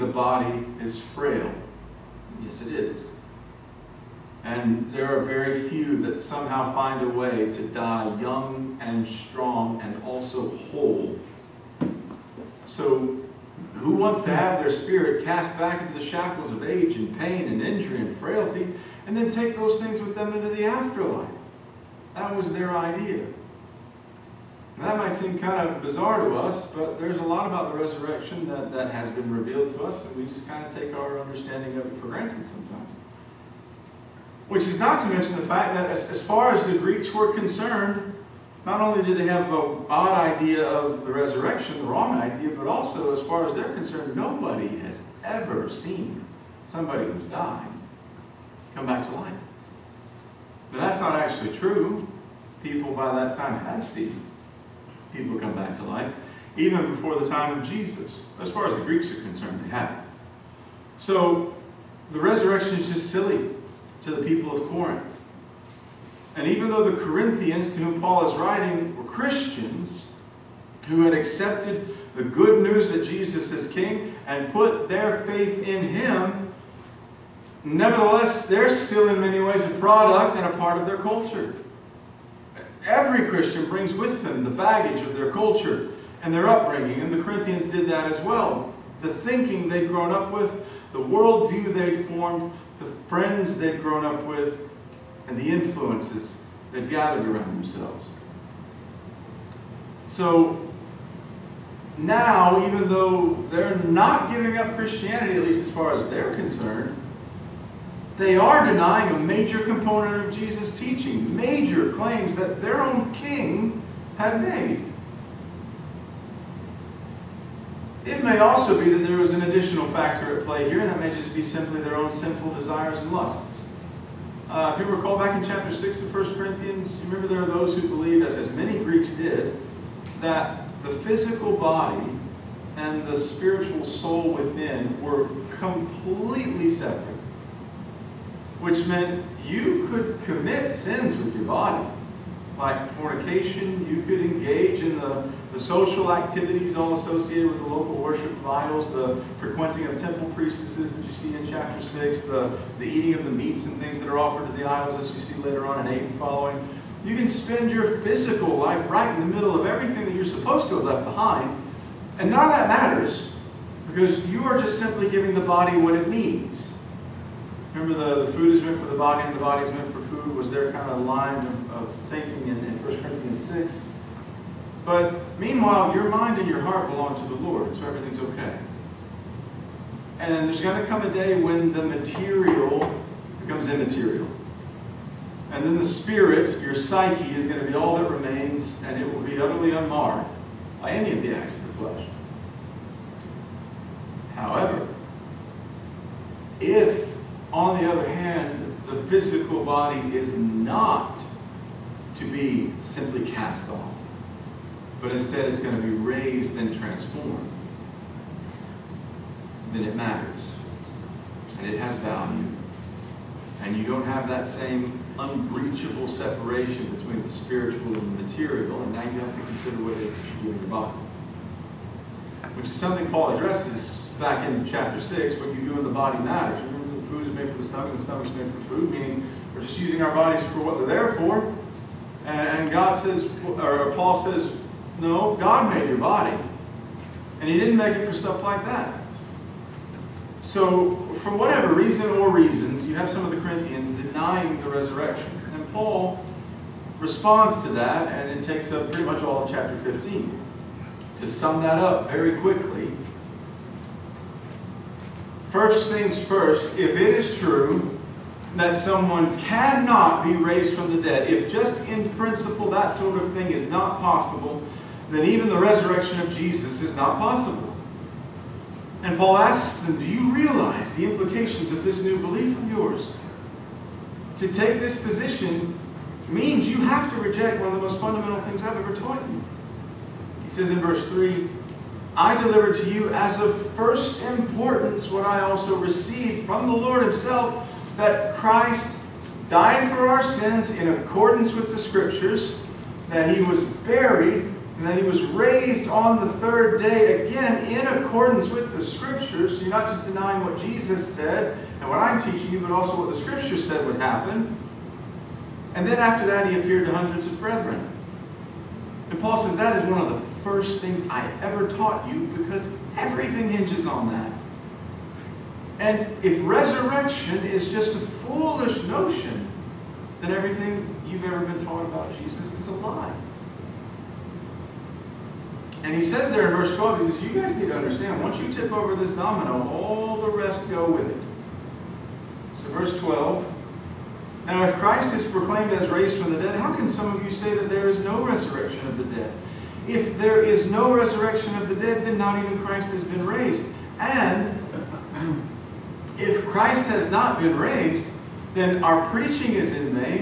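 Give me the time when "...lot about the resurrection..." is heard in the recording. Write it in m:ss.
0:27.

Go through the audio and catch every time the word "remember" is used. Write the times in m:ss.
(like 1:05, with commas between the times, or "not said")
2:07, 2:47.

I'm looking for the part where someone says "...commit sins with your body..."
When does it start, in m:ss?
2:20.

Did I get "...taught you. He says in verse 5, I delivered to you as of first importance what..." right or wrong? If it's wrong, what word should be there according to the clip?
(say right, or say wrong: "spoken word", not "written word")
wrong: "3", not "5".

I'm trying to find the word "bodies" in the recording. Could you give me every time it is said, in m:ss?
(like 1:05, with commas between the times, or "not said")
3:50.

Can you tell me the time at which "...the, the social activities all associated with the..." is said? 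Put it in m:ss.
2:24.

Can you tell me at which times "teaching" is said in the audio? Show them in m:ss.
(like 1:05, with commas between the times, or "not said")
1:50, 5:02.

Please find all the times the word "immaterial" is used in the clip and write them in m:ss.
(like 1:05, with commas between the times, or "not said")
3:03.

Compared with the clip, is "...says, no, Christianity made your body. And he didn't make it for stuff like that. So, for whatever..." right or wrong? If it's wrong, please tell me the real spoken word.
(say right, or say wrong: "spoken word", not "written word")
wrong: "God", not "Christianity".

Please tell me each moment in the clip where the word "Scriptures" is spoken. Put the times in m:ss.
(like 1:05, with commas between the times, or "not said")
4:51, 4:58, 5:03.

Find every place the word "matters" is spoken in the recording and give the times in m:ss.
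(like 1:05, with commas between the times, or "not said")
2:42, 3:29, 3:46.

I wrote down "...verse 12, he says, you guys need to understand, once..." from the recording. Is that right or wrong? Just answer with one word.
right.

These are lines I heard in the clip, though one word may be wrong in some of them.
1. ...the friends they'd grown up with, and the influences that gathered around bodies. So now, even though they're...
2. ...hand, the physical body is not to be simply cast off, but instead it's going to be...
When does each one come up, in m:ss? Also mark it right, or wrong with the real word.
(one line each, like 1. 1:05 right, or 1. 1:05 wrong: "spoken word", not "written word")
1. 1:32 wrong: "themselves", not "bodies"
2. 3:18 right.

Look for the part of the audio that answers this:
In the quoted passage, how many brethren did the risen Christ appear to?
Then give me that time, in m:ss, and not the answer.
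5:06.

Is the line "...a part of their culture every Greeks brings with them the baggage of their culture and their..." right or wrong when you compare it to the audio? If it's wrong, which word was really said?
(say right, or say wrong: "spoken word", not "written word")
wrong: "Christian", not "Greeks".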